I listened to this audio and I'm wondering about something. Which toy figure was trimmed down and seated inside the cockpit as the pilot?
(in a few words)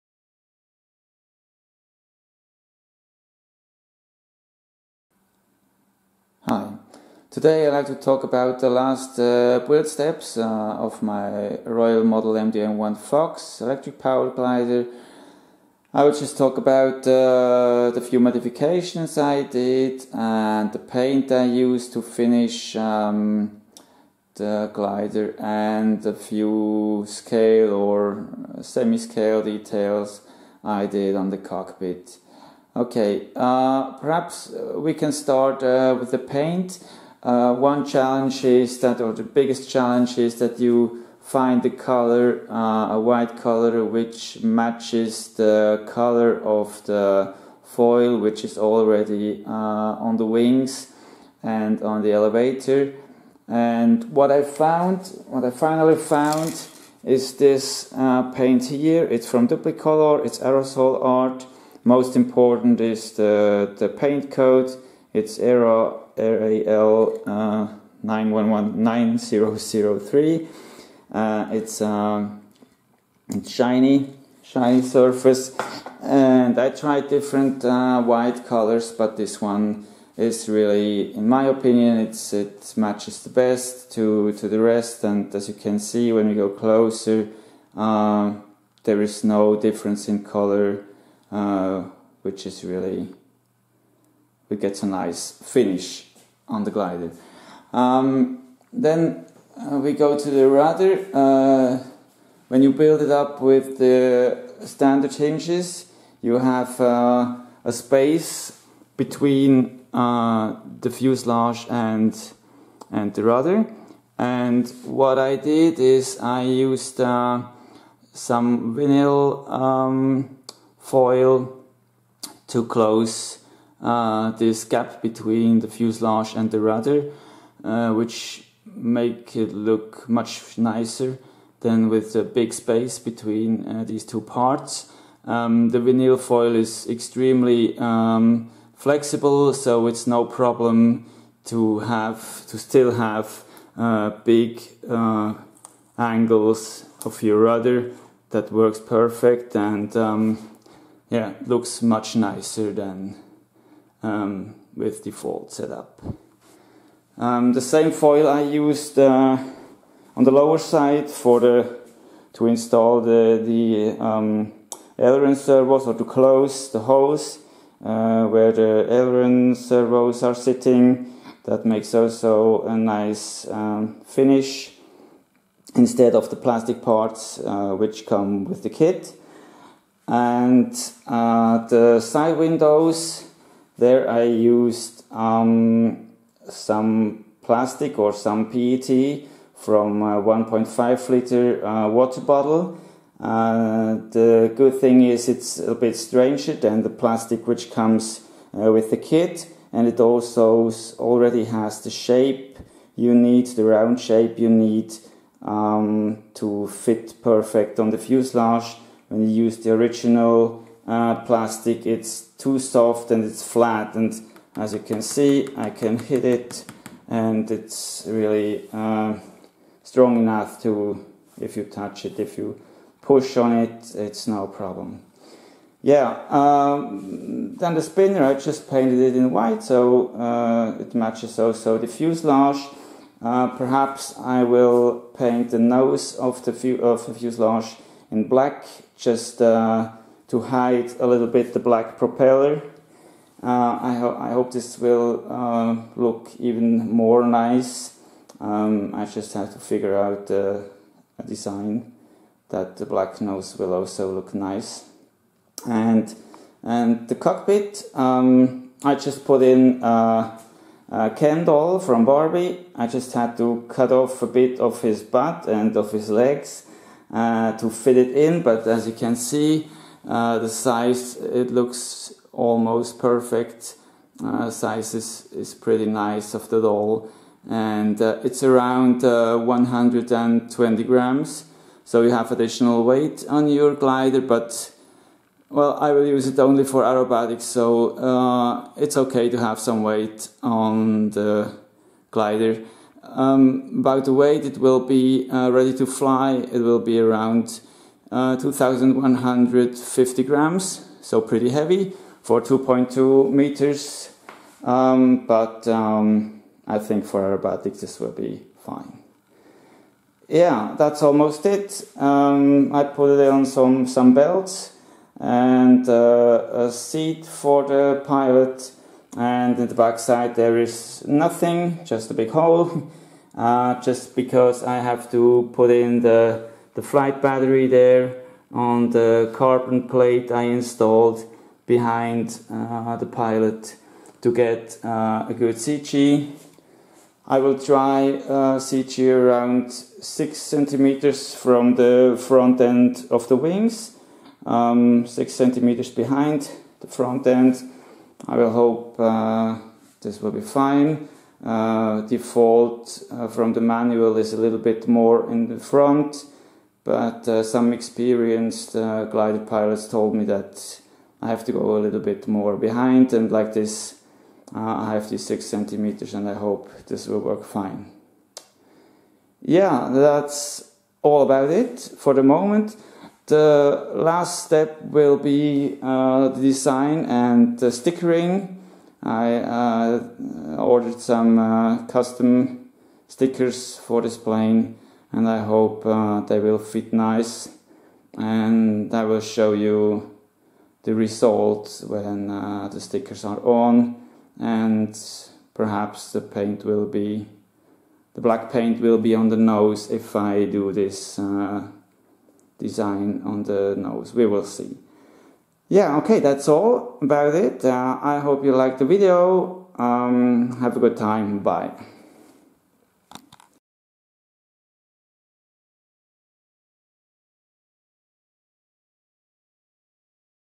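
Ken doll.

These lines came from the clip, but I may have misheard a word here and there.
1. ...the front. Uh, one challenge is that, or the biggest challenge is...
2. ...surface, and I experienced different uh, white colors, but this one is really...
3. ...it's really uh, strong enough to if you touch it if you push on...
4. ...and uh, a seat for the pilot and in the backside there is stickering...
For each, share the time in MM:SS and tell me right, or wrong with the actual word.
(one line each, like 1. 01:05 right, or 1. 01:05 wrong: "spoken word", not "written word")
1. 00:36 wrong: "paint", not "front"
2. 01:14 wrong: "tried", not "experienced"
3. 03:37 right
4. 05:15 wrong: "nothing", not "stickering".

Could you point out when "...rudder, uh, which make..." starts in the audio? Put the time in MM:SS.
02:06.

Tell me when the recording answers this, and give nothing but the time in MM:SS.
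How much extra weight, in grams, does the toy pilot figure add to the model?
04:39.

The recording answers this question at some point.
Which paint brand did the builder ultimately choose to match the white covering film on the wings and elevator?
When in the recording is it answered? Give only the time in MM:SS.
00:59.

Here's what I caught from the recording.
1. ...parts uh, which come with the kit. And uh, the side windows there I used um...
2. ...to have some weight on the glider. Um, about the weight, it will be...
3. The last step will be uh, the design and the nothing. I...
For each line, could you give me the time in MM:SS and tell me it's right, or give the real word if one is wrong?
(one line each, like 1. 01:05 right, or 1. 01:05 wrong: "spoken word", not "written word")
1. 02:56 right
2. 04:49 right
3. 06:13 wrong: "stickering", not "nothing".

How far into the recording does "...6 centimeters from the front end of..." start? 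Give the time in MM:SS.
05:39.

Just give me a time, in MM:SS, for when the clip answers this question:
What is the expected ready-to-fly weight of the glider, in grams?
04:58.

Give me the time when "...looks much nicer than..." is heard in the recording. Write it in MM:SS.
02:31.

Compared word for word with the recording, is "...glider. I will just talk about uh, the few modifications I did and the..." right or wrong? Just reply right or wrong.
right.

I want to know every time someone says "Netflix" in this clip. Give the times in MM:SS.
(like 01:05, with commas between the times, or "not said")
not said.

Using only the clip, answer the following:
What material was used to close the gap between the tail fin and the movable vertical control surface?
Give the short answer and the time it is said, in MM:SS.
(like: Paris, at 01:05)
vinyl foil, at 01:58.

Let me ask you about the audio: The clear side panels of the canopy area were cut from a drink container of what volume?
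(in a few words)
1.5 liter.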